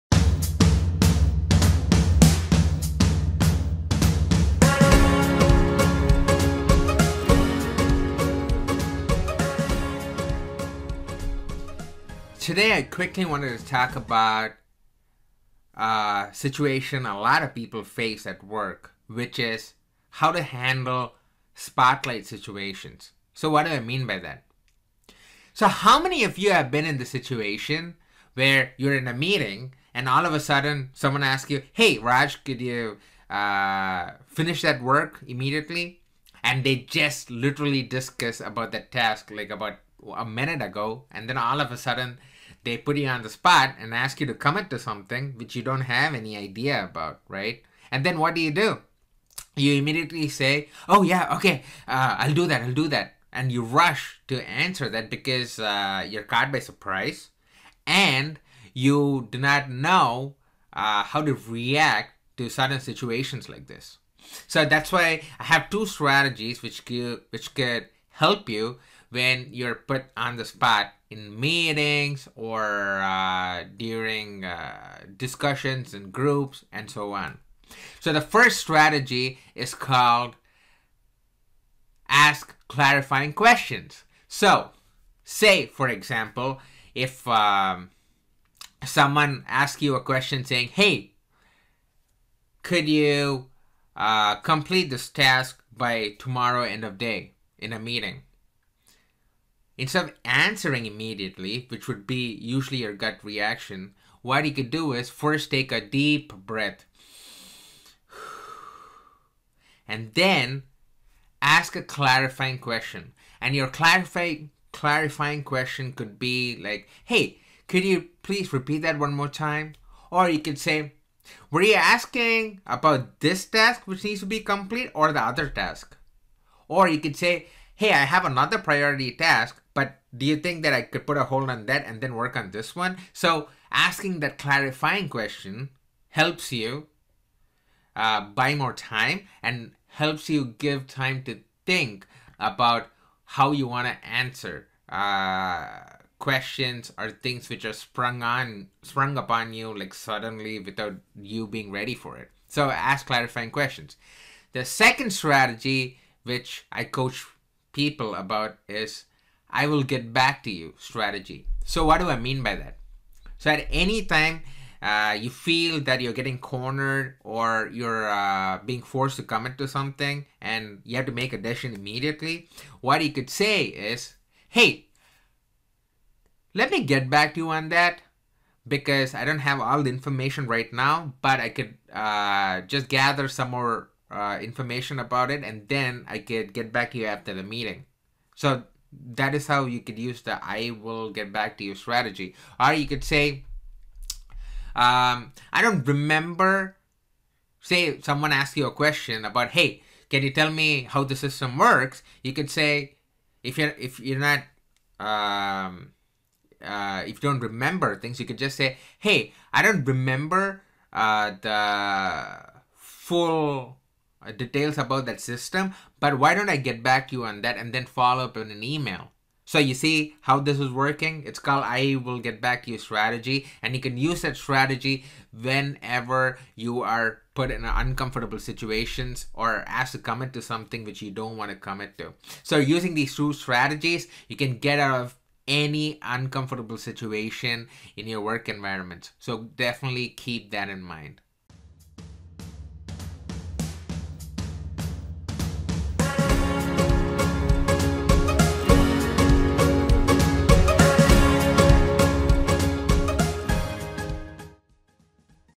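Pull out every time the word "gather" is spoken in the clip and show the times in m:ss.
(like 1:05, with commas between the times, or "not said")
3:02.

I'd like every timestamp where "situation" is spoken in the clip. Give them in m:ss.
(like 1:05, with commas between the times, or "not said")
0:16, 0:22, 0:27, 1:02, 3:48, 3:56.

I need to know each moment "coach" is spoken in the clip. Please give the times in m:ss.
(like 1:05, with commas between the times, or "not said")
2:36.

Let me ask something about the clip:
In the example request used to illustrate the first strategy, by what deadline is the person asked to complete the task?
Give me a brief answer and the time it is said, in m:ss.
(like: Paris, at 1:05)
Tomorrow end of day, at 1:36.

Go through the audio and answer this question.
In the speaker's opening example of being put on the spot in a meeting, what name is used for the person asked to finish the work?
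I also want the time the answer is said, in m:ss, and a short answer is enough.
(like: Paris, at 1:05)
Raj, at 0:31.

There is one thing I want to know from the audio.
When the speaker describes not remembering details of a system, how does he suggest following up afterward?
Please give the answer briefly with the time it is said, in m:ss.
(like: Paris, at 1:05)
In an email, at 3:38.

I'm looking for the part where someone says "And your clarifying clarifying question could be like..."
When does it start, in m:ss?
1:53.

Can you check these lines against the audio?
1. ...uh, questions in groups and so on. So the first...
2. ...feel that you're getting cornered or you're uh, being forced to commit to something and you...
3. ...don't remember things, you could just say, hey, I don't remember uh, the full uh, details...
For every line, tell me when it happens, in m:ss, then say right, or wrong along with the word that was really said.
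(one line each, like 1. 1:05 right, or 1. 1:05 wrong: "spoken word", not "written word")
1. 1:14 wrong: "discussions", not "questions"
2. 2:45 right
3. 3:27 right.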